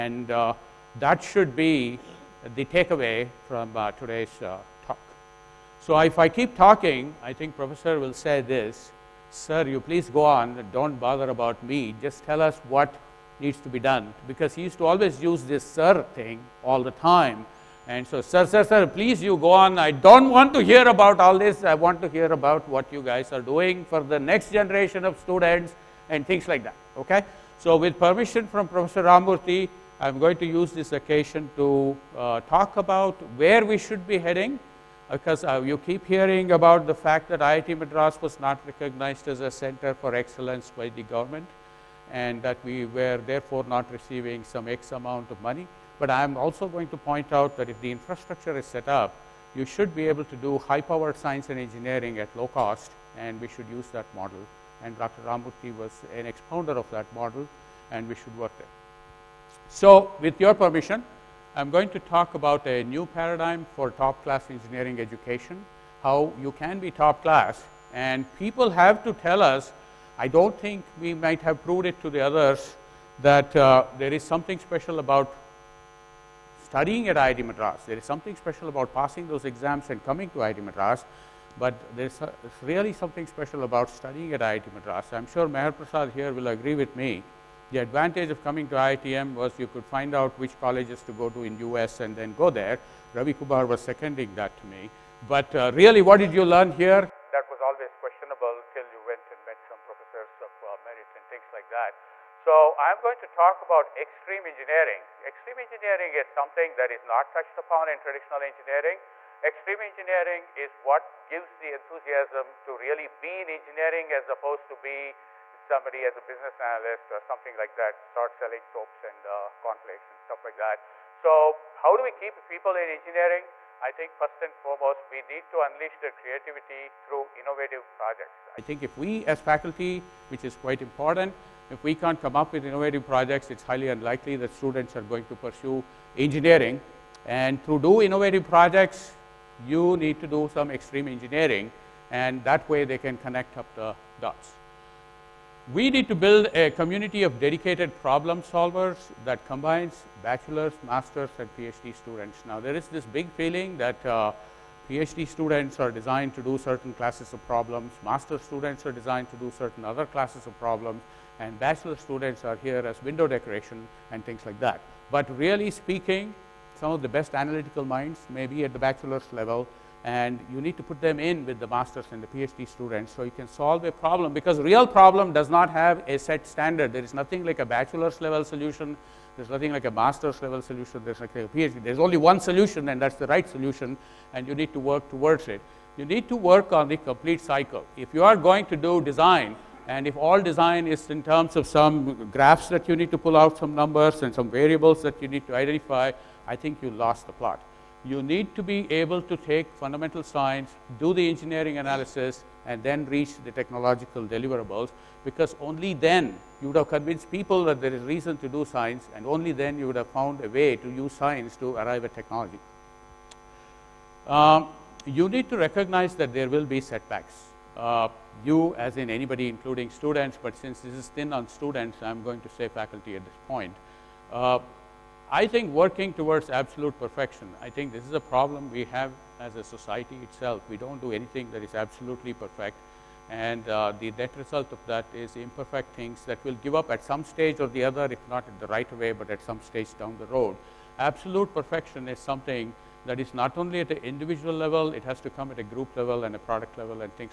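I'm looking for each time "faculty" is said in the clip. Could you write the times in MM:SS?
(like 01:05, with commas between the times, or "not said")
02:09, 03:42.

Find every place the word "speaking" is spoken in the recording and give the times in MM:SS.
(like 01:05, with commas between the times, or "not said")
02:45.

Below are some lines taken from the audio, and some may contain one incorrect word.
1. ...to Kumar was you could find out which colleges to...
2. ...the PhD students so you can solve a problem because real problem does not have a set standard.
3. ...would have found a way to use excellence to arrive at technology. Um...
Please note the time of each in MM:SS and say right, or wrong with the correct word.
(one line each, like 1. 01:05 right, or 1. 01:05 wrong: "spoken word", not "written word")
1. 01:28 wrong: "IITM", not "Kumar"
2. 02:52 right
3. 03:29 wrong: "science", not "excellence".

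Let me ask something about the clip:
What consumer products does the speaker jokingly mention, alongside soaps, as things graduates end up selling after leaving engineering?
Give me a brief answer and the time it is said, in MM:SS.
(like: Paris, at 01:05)
Cornflakes, at 01:59.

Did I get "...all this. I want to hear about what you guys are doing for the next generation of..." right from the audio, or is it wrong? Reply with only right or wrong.
right.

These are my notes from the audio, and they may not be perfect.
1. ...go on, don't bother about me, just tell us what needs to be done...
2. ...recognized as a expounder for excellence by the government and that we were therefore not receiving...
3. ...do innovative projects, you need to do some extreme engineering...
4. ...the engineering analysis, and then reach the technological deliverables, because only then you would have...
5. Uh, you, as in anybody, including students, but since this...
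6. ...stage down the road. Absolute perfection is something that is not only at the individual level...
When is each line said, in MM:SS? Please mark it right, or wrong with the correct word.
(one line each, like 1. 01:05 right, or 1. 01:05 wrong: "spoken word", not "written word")
1. 00:10 right
2. 00:38 wrong: "center", not "expounder"
3. 02:17 right
4. 03:21 right
5. 03:37 right
6. 03:59 right.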